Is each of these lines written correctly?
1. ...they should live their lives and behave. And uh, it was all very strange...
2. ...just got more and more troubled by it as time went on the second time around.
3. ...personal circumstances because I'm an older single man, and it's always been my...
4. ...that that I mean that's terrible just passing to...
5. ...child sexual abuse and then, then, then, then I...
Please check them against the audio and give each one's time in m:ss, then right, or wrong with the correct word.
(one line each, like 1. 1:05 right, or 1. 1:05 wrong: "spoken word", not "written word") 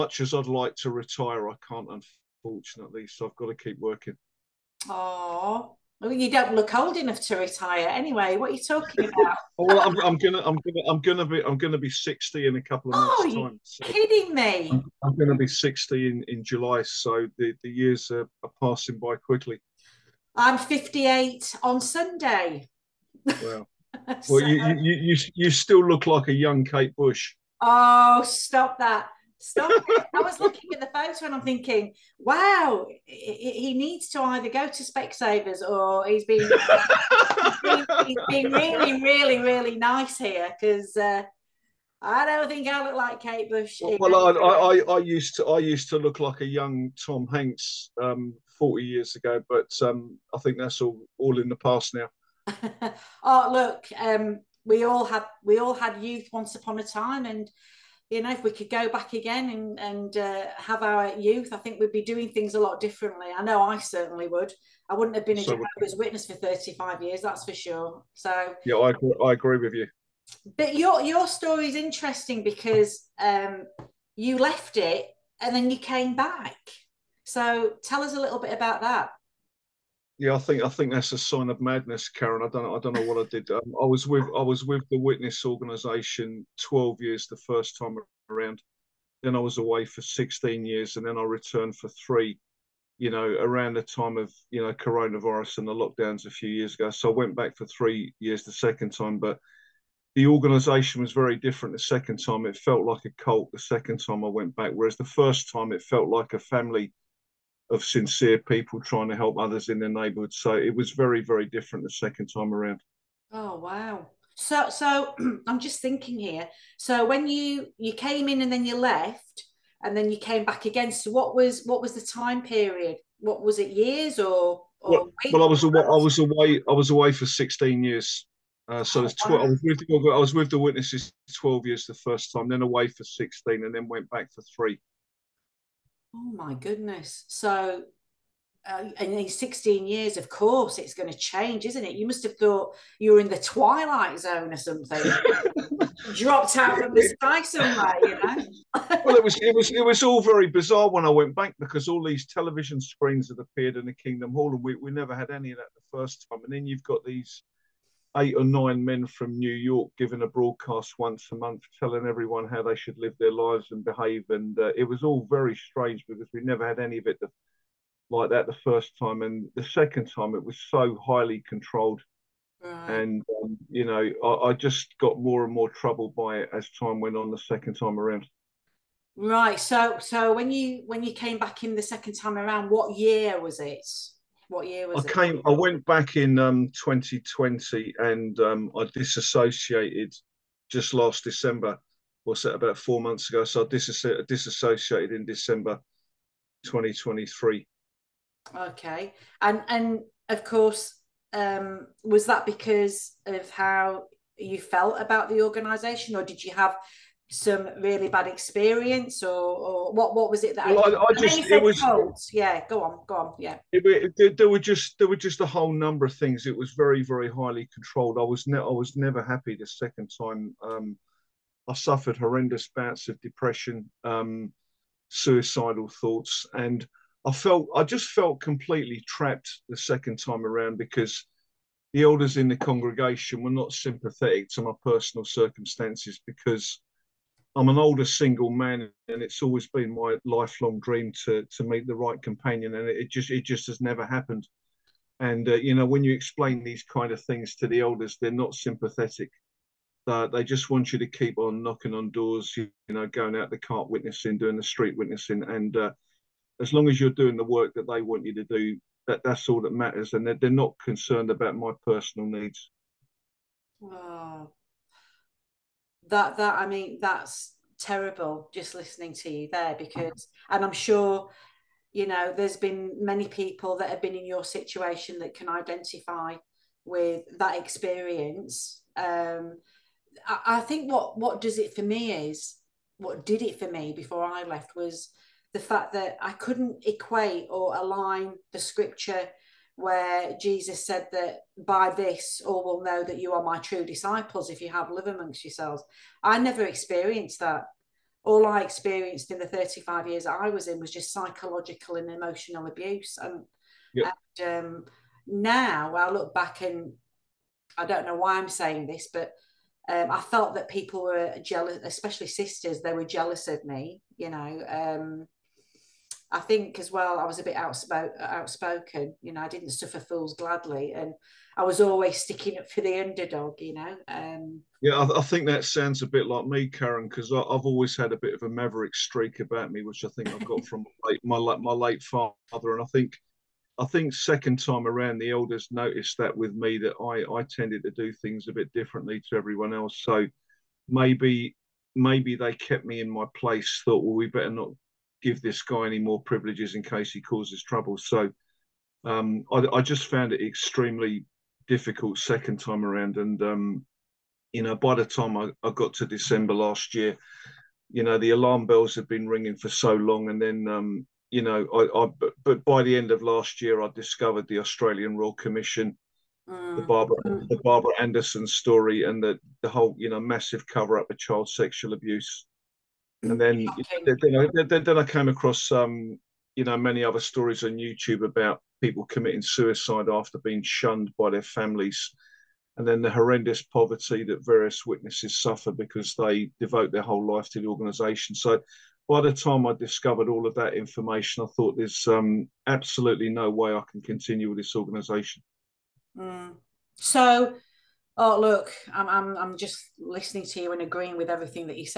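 1. 2:42 right
2. 2:54 right
3. 3:54 right
4. 4:26 wrong: "listening", not "passing"
5. 6:11 right.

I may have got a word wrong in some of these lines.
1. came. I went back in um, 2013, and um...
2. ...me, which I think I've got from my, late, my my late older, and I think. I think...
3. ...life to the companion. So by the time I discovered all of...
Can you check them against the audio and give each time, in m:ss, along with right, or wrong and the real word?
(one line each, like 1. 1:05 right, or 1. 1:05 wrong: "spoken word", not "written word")
1. 3:05 wrong: "2020", not "2013"
2. 5:29 wrong: "father", not "older"
3. 6:27 wrong: "organisation", not "companion".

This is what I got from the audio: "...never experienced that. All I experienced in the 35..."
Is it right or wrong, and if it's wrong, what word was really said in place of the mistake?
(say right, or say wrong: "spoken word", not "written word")
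right.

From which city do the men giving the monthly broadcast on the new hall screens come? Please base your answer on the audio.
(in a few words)
New York.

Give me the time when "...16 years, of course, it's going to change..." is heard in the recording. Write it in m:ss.
2:19.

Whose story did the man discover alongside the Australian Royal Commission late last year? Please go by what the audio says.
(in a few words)
Barbara Anderson.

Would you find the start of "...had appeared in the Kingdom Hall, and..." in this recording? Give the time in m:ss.
2:33.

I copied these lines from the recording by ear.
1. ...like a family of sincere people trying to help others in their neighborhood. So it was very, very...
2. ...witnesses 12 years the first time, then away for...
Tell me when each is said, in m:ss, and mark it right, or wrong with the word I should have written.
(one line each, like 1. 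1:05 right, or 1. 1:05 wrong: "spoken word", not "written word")
1. 1:46 right
2. 2:10 right.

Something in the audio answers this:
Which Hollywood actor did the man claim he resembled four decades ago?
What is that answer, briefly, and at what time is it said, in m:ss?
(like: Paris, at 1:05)
Tom Hanks, at 0:47.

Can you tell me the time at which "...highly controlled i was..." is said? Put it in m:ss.
3:37.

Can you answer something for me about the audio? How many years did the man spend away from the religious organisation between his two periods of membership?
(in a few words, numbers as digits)
16.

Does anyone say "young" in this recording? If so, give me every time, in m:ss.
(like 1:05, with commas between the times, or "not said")
0:26, 0:46.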